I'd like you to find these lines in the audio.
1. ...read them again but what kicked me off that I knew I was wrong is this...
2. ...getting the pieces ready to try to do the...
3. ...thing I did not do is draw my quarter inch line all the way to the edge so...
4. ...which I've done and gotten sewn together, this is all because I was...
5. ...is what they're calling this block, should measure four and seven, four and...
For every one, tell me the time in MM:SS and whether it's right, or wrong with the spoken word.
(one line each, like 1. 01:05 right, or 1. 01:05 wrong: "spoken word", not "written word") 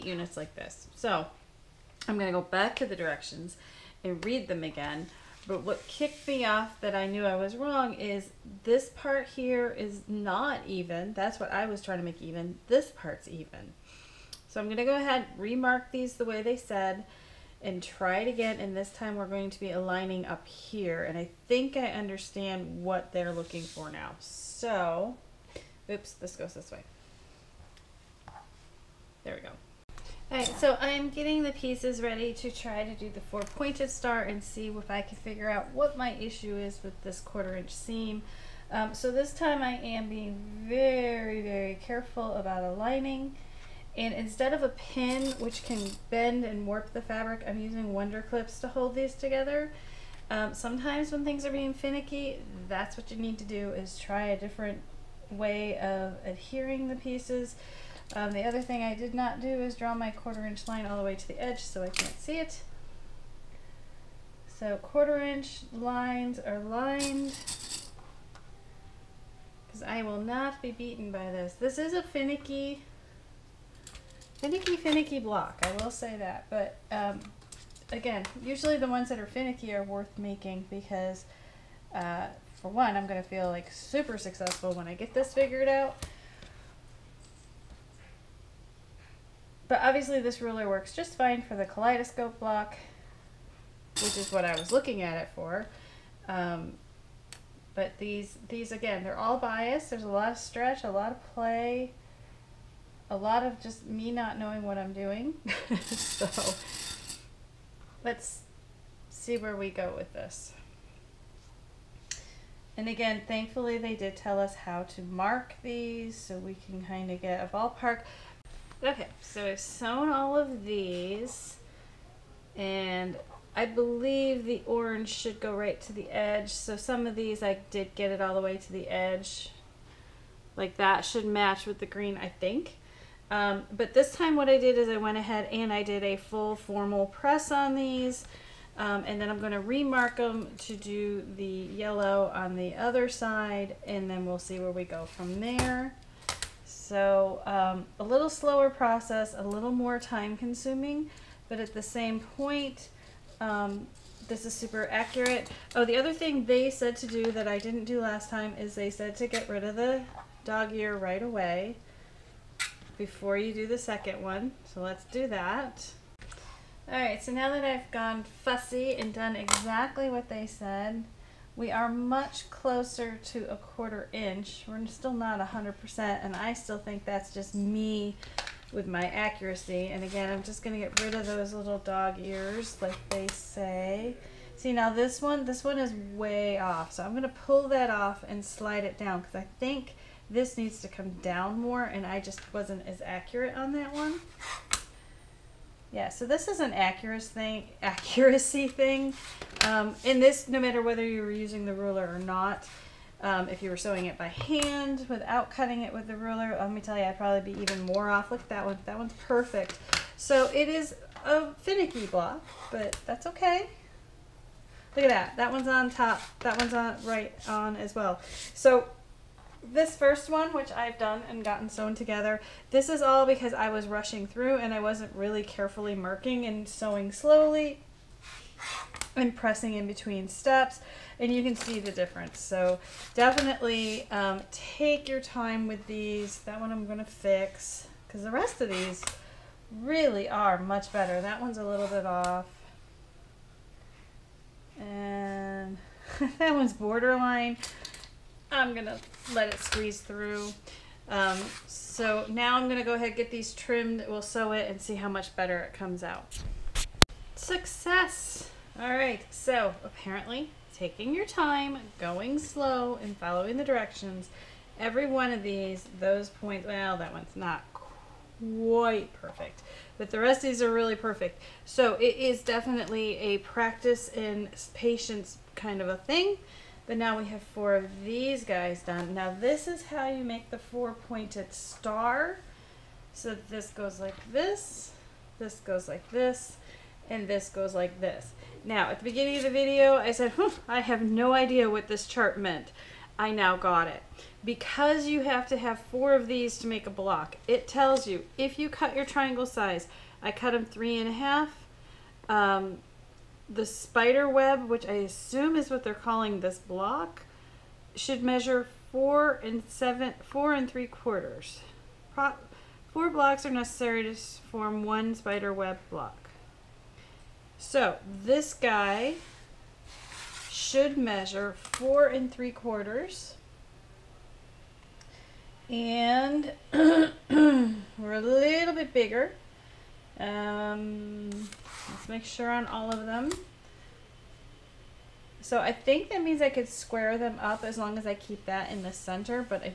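1. 00:04 right
2. 00:31 right
3. 00:58 right
4. 03:40 right
5. 05:05 right.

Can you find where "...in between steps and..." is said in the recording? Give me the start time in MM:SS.
03:49.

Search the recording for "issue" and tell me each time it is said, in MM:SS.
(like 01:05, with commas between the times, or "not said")
00:36.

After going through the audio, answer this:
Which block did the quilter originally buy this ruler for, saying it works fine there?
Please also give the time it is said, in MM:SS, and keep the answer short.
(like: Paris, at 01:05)
kaleidoscope block, at 01:31.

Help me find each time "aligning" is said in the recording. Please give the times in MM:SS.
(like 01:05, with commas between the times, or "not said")
00:19, 00:42.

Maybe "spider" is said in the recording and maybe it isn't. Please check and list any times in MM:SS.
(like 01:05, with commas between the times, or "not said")
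05:03, 05:15.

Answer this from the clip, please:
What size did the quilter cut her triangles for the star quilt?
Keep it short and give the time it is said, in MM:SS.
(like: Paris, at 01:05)
3 1/2, at 05:00.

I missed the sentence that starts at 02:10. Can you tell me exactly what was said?
Like that should match with the green, I think.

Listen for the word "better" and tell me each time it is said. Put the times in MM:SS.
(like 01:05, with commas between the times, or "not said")
04:00, 04:15.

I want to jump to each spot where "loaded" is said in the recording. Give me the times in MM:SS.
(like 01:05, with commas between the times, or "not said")
not said.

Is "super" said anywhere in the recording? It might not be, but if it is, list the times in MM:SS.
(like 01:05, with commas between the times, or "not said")
01:23, 02:34.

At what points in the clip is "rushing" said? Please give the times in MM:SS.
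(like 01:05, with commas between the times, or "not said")
03:43.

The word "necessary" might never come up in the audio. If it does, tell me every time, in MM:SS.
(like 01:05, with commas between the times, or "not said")
05:13.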